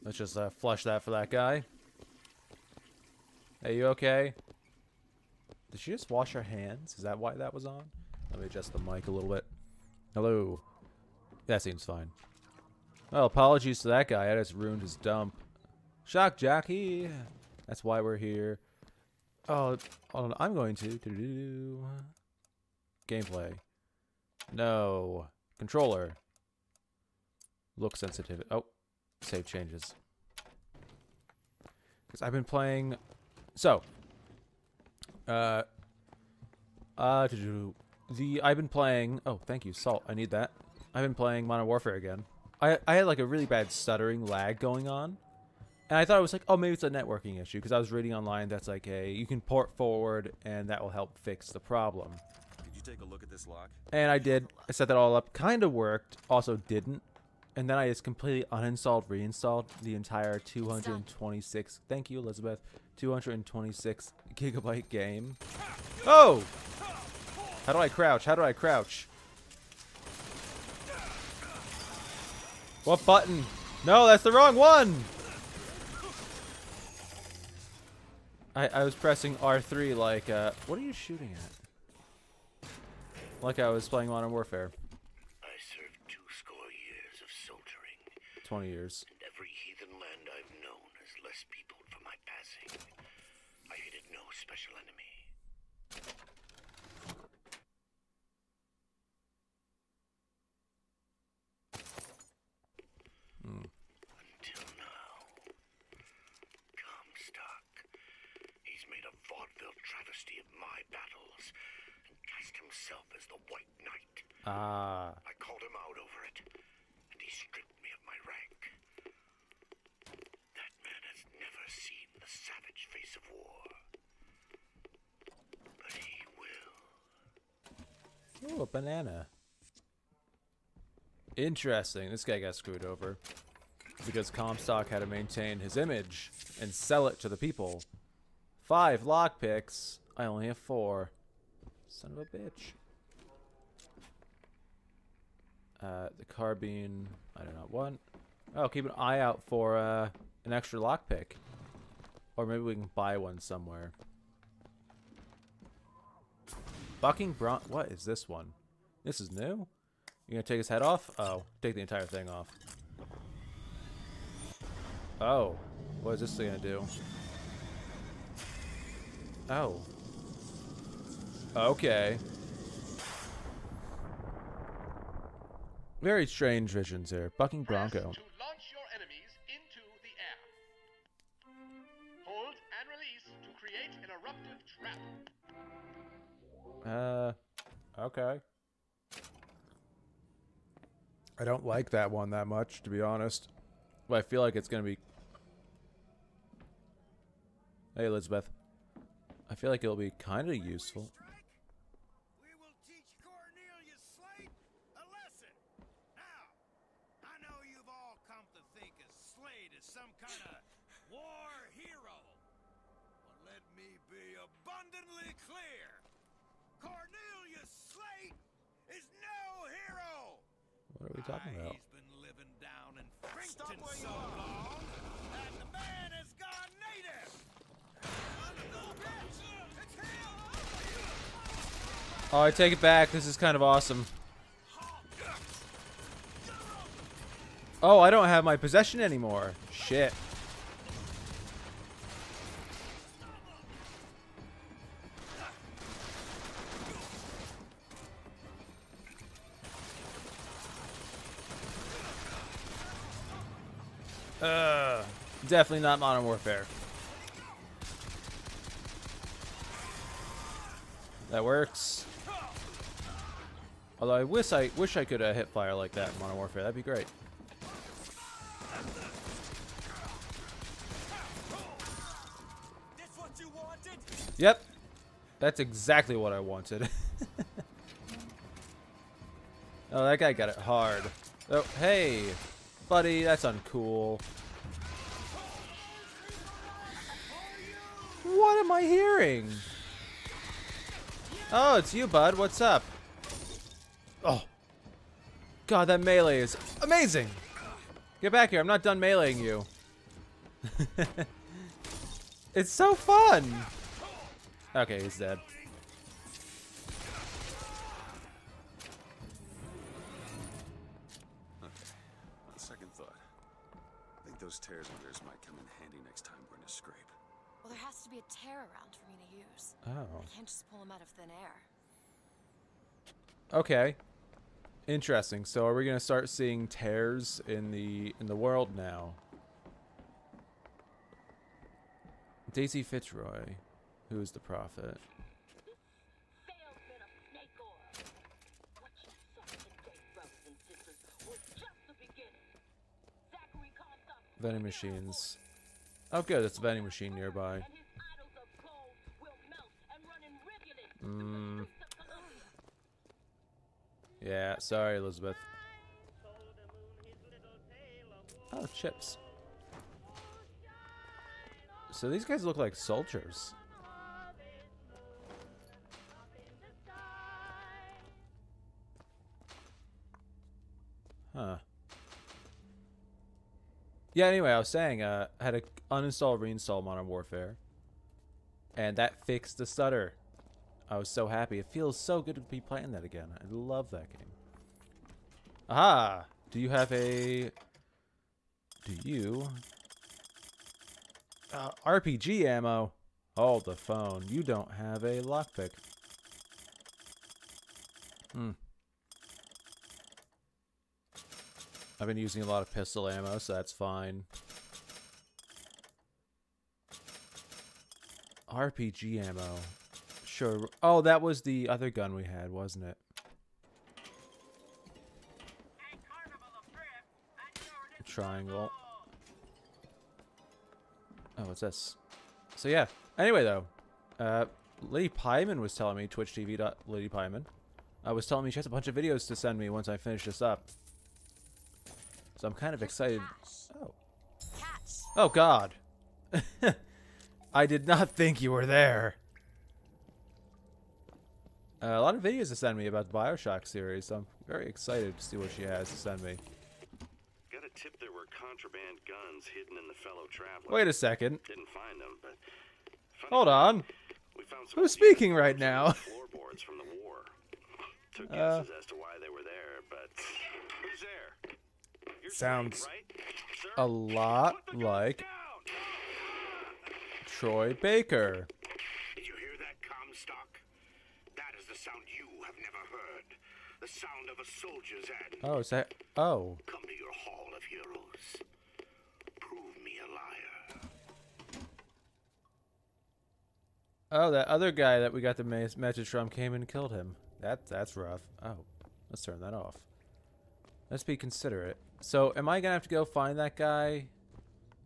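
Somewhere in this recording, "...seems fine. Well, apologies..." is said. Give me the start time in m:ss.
0:11.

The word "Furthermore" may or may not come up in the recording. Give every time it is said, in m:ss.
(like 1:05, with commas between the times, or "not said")
not said.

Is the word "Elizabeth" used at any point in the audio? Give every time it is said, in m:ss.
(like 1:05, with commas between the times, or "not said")
1:02, 3:18, 5:54.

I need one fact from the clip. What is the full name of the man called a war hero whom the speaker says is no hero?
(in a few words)
Cornelius Slate.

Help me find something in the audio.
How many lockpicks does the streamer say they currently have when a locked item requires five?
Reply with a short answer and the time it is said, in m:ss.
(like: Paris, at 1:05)
4, at 2:20.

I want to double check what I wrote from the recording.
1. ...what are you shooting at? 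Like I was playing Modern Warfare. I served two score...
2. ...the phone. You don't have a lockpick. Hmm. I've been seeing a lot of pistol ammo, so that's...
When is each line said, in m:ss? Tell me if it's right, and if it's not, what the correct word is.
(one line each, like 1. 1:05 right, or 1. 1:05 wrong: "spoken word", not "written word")
1. 1:20 right
2. 6:33 wrong: "using", not "seeing".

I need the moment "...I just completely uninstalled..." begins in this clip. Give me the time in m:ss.
0:57.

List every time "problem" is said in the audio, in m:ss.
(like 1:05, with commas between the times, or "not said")
0:51.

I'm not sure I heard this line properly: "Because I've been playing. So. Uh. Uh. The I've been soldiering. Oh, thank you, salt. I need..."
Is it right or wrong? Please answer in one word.
wrong.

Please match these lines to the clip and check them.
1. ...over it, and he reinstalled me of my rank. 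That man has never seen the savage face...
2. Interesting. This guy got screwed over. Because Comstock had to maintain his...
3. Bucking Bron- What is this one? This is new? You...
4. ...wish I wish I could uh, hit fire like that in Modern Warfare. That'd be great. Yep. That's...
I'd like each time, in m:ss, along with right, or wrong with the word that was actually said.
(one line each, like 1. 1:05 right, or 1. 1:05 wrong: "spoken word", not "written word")
1. 1:55 wrong: "stripped", not "reinstalled"
2. 2:11 right
3. 2:36 right
4. 4:24 right.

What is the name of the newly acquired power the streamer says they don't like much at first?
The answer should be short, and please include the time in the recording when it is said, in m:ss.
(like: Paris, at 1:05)
Bucking Bronco, at 2:57.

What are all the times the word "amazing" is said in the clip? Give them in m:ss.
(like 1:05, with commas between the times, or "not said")
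4:56.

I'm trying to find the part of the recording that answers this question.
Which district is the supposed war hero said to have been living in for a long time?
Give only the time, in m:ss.
3:43.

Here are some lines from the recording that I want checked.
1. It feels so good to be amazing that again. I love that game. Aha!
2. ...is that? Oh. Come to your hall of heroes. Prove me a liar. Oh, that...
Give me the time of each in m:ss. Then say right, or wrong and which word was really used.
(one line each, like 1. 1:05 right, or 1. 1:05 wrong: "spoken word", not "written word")
1. 6:21 wrong: "playing", not "amazing"
2. 7:55 right.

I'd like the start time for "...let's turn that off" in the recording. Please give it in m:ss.
8:09.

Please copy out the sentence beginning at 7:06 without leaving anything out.
Lady Pyman, I uh, was telling me she has a bunch of videos to send me once I finish this up.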